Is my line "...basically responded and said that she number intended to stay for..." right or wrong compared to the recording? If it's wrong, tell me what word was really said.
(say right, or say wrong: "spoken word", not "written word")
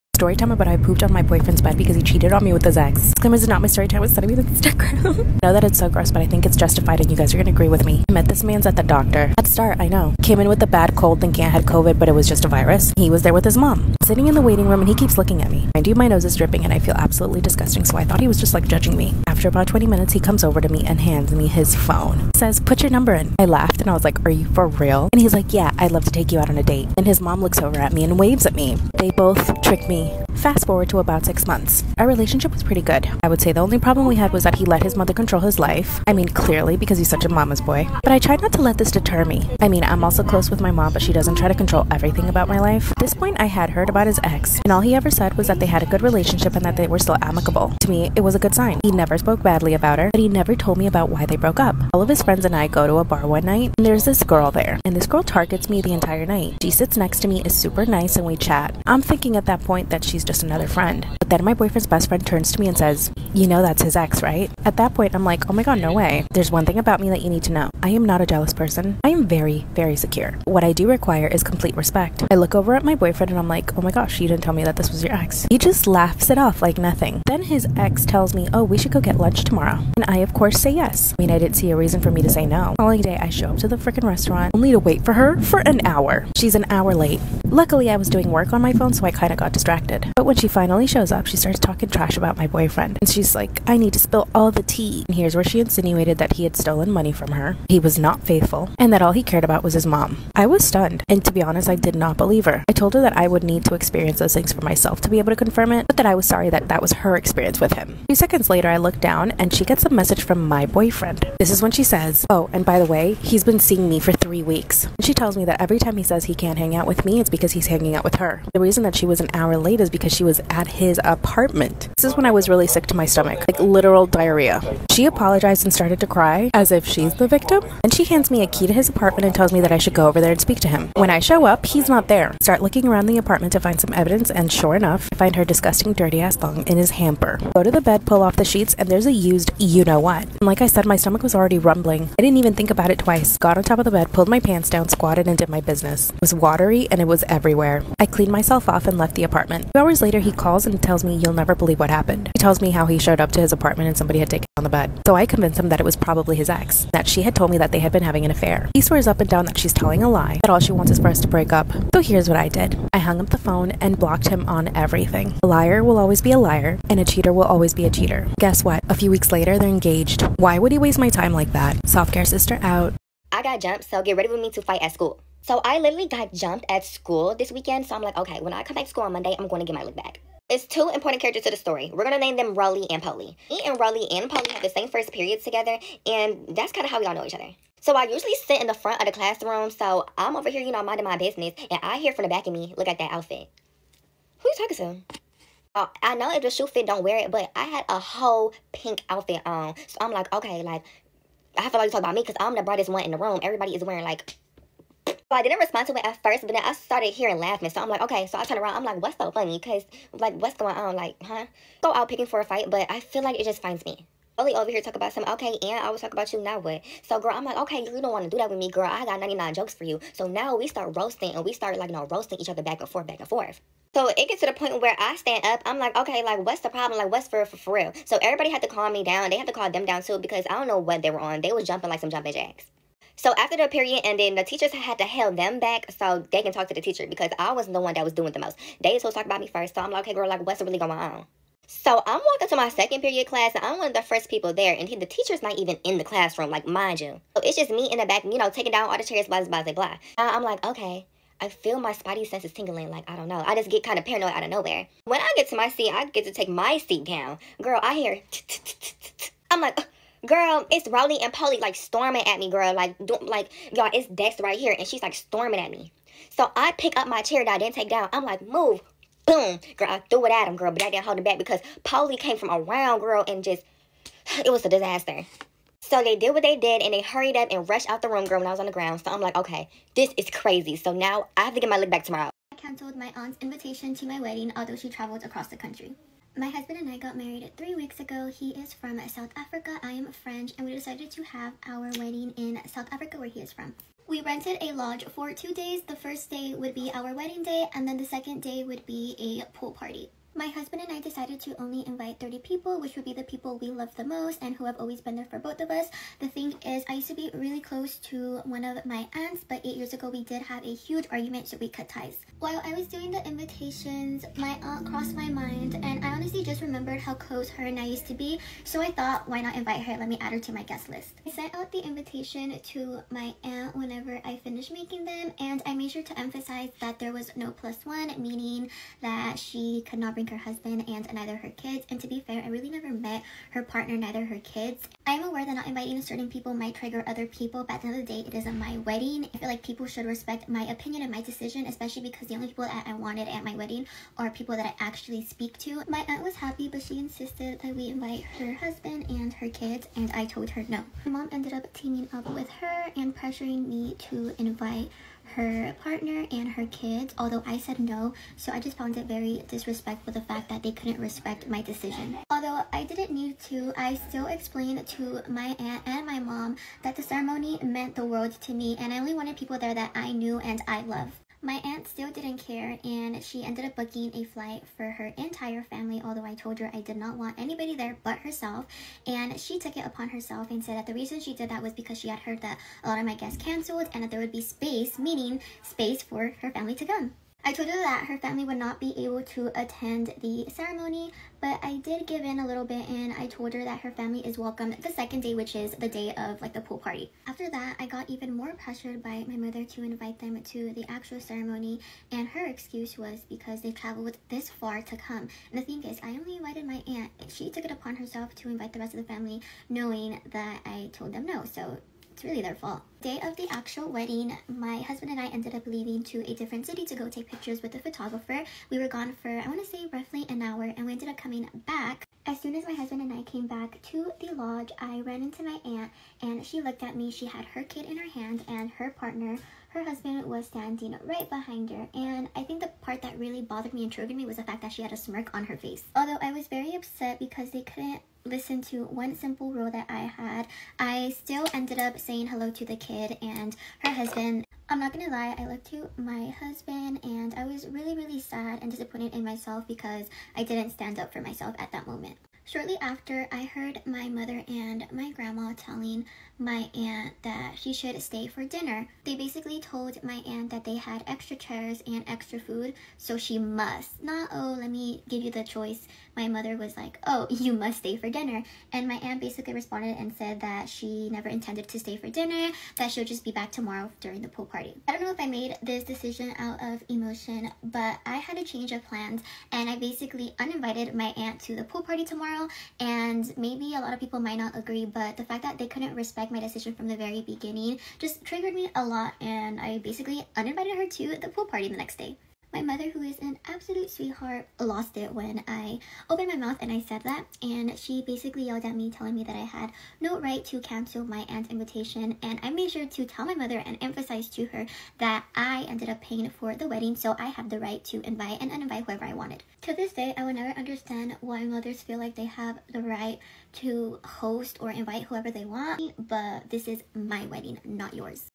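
wrong: "never", not "number".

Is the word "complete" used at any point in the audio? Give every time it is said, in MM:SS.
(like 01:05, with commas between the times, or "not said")
01:11.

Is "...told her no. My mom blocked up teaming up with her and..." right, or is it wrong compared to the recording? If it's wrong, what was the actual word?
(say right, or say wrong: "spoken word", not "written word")
wrong: "ended", not "blocked".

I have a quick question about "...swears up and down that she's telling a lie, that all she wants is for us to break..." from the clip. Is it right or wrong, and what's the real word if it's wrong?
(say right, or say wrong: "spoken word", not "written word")
right.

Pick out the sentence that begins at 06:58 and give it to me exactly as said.
We were gone for, I want to say, roughly an hour, and we ended up coming back.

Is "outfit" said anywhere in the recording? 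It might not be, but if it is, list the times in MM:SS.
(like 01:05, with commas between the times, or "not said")
03:13, 03:19.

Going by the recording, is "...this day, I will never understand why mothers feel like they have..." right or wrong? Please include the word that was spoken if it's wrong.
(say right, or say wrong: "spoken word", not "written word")
right.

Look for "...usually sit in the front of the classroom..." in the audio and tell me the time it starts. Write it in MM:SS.
03:08.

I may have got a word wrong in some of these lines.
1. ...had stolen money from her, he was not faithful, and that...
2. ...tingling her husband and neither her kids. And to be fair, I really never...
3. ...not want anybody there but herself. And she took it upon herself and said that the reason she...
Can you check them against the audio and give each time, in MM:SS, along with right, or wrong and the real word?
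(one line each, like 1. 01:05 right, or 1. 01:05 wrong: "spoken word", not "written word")
1. 01:36 right
2. 05:30 wrong: "bring", not "tingling"
3. 06:16 right.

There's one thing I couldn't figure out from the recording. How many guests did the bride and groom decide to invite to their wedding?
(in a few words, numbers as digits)
30.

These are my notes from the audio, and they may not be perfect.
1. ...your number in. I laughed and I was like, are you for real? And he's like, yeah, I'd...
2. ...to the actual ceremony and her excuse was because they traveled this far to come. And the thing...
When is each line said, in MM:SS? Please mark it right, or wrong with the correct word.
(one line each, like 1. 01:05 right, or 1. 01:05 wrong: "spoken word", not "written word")
1. 00:22 right
2. 06:40 right.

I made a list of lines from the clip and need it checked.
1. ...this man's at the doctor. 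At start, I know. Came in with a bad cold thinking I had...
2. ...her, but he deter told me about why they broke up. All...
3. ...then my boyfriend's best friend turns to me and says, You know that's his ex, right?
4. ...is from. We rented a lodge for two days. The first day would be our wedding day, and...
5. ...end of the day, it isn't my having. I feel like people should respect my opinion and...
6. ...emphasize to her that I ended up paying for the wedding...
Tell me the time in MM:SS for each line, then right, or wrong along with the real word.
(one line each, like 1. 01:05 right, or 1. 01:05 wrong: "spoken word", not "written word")
1. 00:08 right
2. 00:49 wrong: "never", not "deter"
3. 01:01 right
4. 04:53 right
5. 05:37 wrong: "wedding", not "having"
6. 08:23 right.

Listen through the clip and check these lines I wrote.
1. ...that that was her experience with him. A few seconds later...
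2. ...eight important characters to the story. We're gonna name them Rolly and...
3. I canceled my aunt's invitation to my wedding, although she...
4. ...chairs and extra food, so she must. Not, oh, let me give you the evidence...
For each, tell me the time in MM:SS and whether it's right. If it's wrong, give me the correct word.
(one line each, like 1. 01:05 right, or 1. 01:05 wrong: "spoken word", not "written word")
1. 01:46 right
2. 03:00 wrong: "two", not "eight"
3. 04:42 right
4. 07:41 wrong: "choice", not "evidence".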